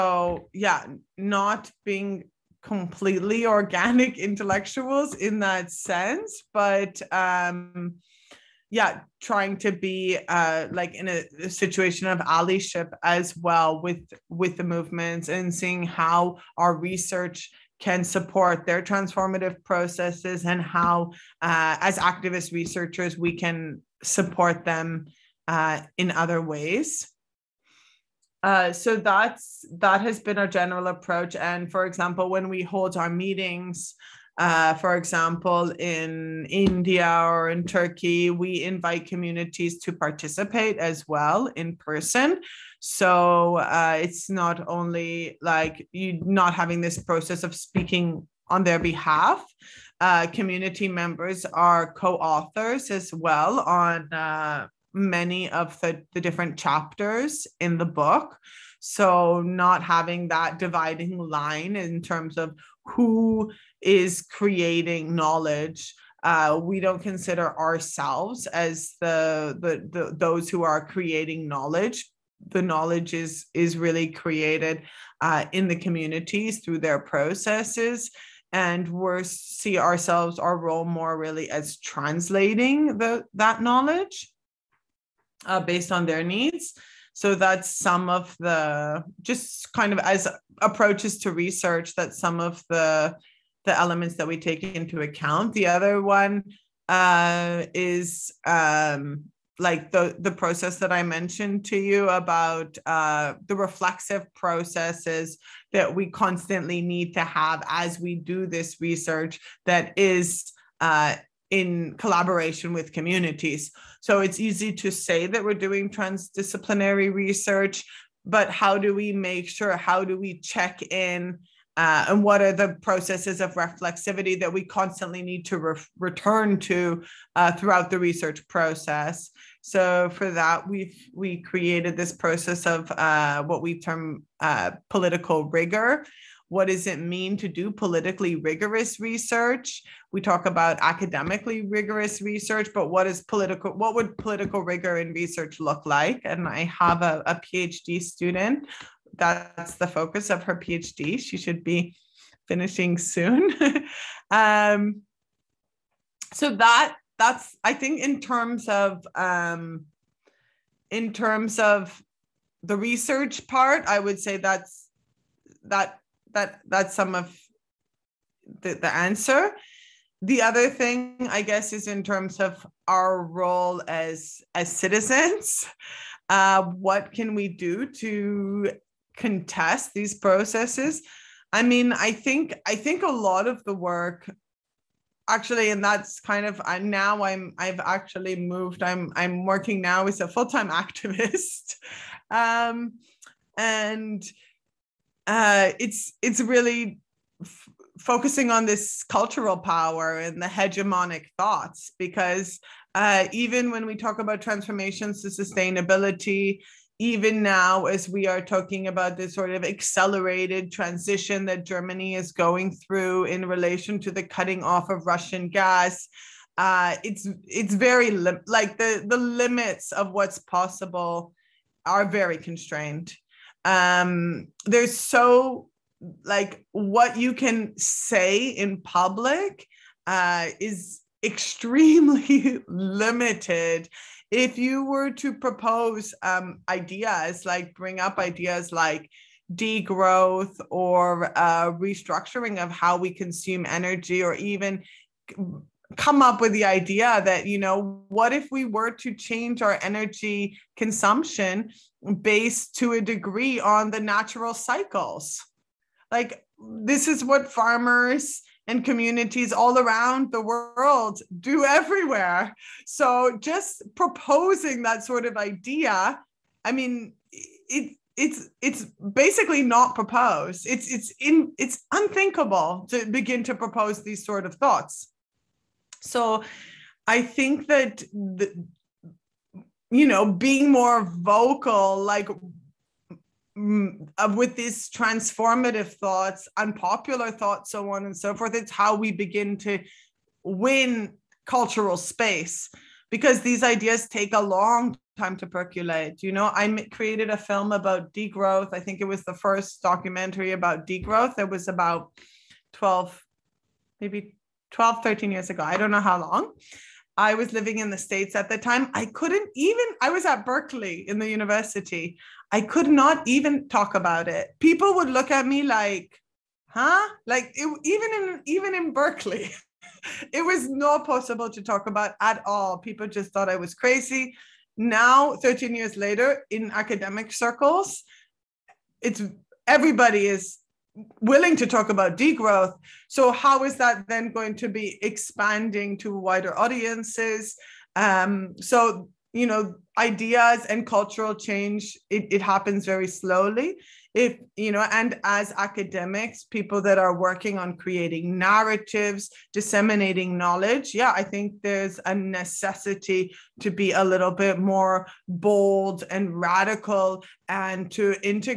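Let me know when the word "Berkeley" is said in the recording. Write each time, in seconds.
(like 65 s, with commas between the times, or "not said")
310 s, 318 s.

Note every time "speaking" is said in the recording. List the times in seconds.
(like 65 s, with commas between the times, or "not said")
47 s.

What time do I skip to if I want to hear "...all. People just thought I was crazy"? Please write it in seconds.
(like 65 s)
322 s.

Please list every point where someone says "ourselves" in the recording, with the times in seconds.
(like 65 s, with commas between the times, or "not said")
67 s, 79 s.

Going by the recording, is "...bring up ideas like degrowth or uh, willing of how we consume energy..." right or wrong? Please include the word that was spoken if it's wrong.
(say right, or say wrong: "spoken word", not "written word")
wrong: "restructuring", not "willing".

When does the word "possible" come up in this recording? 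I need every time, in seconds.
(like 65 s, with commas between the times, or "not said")
220 s, 321 s.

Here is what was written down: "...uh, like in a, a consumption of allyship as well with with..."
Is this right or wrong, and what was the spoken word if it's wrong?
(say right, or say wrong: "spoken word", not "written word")
wrong: "situation", not "consumption".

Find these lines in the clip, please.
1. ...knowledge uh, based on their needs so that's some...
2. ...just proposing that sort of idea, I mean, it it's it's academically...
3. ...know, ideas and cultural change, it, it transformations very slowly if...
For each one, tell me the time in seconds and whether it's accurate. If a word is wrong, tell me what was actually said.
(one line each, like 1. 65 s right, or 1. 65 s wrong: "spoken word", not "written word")
1. 83 s right
2. 263 s wrong: "basically", not "academically"
3. 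339 s wrong: "happens", not "transformations".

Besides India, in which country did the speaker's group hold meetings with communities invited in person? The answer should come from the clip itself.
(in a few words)
Turkey.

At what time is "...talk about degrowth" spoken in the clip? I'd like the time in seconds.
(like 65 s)
331 s.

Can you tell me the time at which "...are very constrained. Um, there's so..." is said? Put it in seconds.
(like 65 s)
221 s.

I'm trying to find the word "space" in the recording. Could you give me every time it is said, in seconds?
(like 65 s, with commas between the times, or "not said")
291 s.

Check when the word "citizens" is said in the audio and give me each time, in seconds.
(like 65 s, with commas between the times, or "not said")
174 s.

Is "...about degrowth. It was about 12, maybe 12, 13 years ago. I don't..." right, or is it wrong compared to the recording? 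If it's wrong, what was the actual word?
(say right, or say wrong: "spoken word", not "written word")
right.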